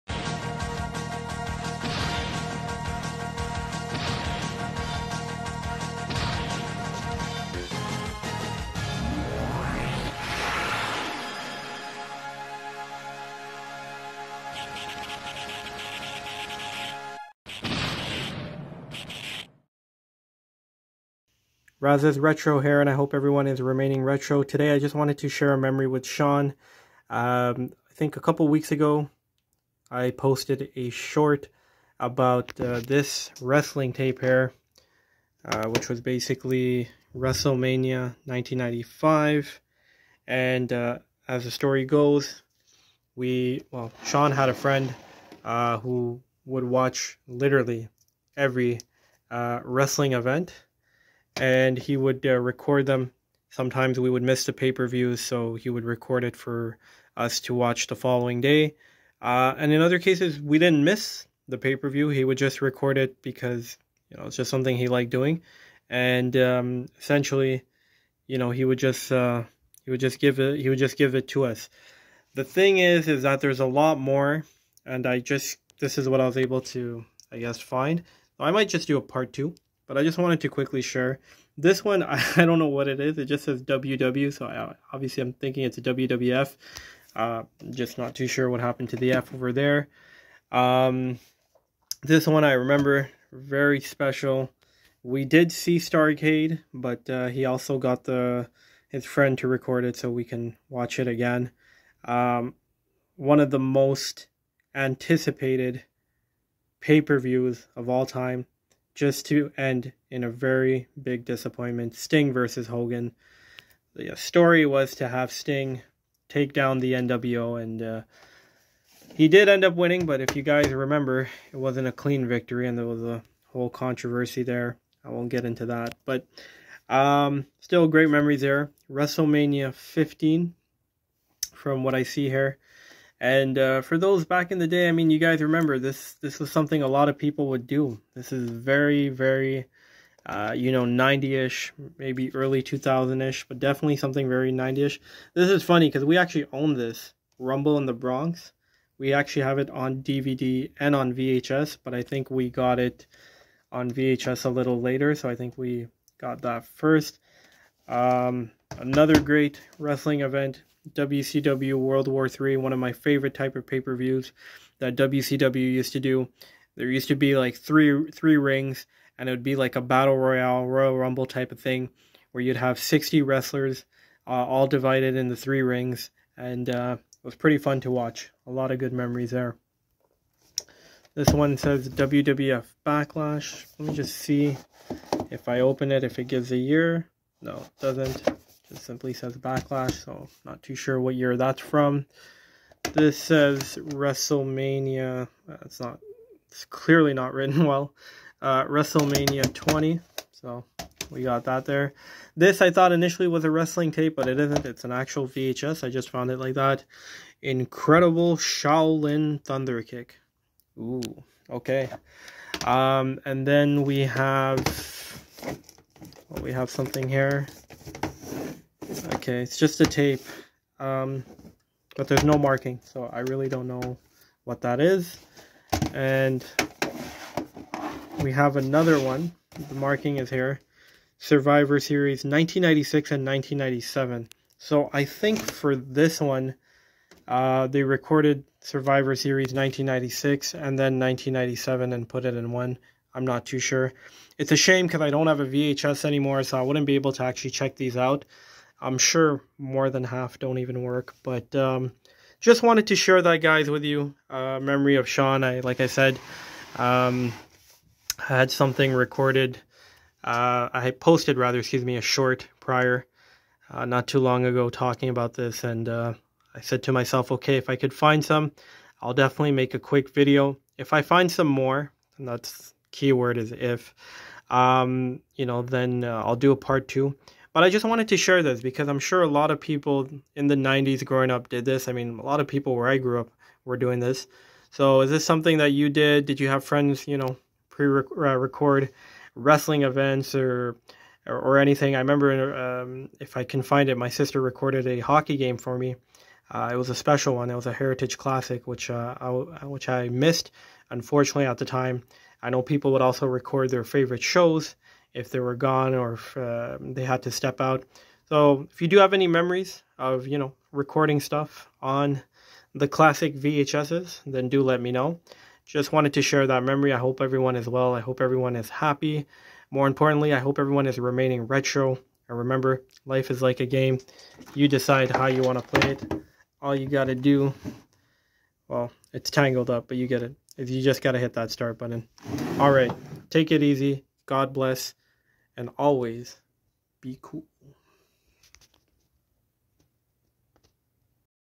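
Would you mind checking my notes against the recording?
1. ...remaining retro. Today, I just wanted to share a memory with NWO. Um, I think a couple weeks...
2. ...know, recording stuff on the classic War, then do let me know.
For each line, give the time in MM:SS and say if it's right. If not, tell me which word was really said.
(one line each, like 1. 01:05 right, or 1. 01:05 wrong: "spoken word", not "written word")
1. 00:23 wrong: "Shan", not "NWO"
2. 05:10 wrong: "VHSs", not "War".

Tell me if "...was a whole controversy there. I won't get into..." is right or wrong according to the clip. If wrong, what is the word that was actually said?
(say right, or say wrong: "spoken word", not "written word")
right.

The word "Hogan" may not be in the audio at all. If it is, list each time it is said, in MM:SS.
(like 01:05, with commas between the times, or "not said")
01:52.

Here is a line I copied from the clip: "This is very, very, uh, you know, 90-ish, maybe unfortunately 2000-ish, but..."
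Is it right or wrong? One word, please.
wrong.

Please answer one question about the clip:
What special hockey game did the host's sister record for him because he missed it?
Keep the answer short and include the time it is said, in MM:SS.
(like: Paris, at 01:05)
Heritage Classic, at 04:57.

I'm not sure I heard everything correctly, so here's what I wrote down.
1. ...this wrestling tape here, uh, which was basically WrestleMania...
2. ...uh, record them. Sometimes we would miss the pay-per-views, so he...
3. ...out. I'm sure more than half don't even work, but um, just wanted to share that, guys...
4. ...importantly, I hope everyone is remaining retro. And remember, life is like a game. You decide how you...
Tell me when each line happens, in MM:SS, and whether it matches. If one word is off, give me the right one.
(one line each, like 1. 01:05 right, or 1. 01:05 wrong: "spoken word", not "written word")
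1. 00:32 right
2. 00:52 right
3. 04:07 right
4. 05:19 right.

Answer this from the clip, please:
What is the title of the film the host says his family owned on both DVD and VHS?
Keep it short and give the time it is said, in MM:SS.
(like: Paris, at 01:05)
Rumble in the Bronx, at 02:27.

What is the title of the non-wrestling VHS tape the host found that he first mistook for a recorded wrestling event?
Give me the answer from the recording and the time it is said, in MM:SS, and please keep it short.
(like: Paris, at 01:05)
Incredible Shaolin Thunder Kick, at 03:27.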